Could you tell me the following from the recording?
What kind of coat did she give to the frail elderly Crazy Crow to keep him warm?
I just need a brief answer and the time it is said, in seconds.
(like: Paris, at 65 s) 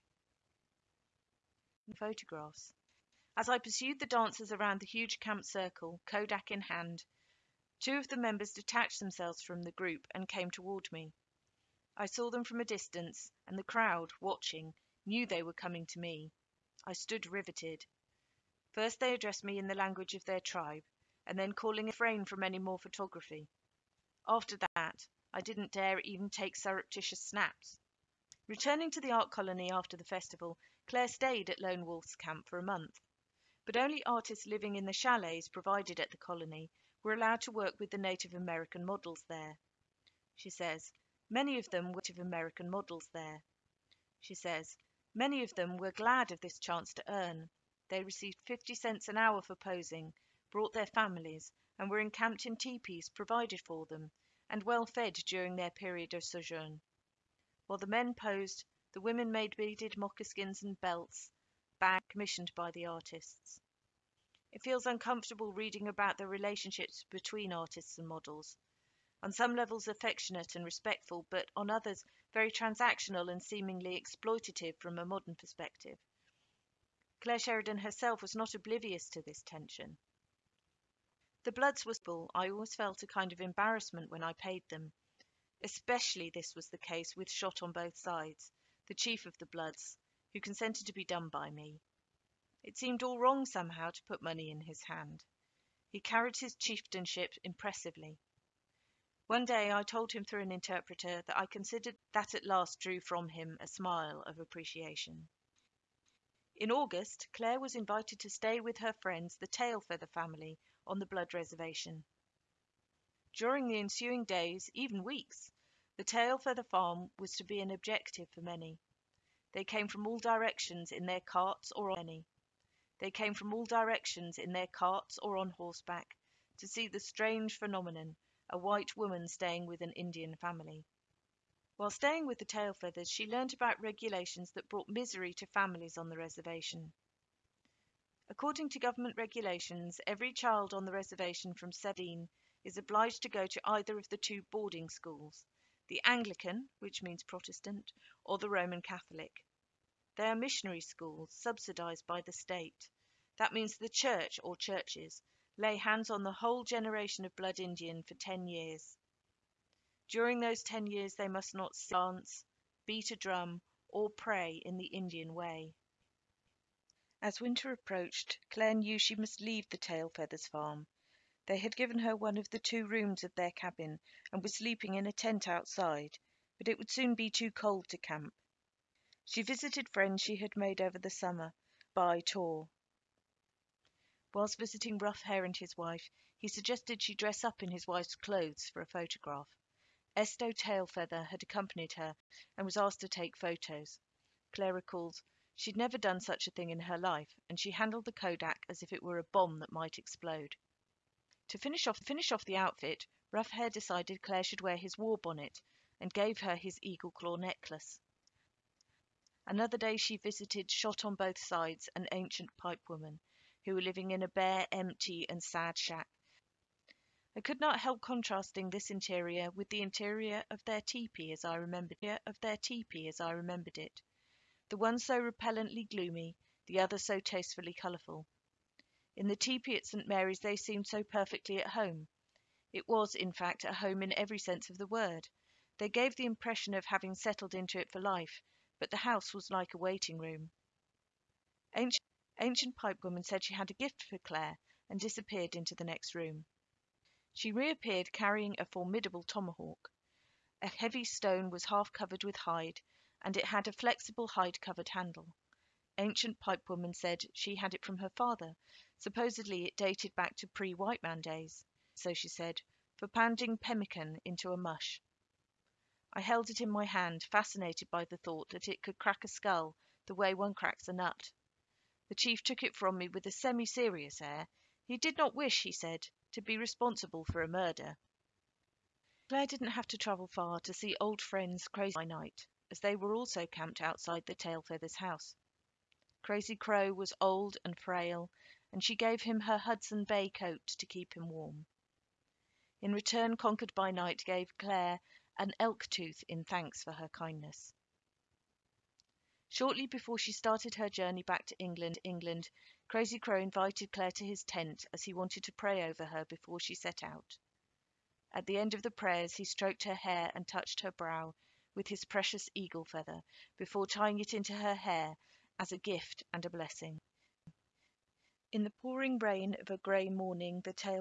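Hudson Bay coat, at 289 s.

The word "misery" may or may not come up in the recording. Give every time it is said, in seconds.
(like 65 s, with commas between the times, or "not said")
134 s.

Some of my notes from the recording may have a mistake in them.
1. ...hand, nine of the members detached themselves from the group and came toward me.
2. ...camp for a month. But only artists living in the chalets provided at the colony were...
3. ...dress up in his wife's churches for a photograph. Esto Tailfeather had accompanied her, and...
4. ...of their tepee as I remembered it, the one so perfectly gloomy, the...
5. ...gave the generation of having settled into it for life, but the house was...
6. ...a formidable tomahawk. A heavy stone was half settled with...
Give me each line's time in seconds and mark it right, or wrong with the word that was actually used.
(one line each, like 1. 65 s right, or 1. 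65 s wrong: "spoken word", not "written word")
1. 6 s wrong: "two", not "nine"
2. 32 s right
3. 187 s wrong: "clothes", not "churches"
4. 220 s wrong: "repellently", not "perfectly"
5. 235 s wrong: "impression", not "generation"
6. 248 s wrong: "covered", not "settled".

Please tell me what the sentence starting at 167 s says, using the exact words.
As winter approached, Clare knew she must leave the Tail Feathers farm.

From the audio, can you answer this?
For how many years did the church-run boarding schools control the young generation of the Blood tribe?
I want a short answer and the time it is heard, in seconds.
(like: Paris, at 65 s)
10 years, at 158 s.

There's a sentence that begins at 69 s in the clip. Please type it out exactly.
On some levels affectionate and respectful, but on others very transactional and seemingly exploitative from a modern perspective.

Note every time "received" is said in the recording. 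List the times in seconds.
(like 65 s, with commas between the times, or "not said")
48 s.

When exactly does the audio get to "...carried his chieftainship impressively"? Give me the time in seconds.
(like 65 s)
96 s.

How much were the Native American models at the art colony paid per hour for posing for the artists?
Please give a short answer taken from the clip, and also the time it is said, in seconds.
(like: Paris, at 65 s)
50 cents, at 48 s.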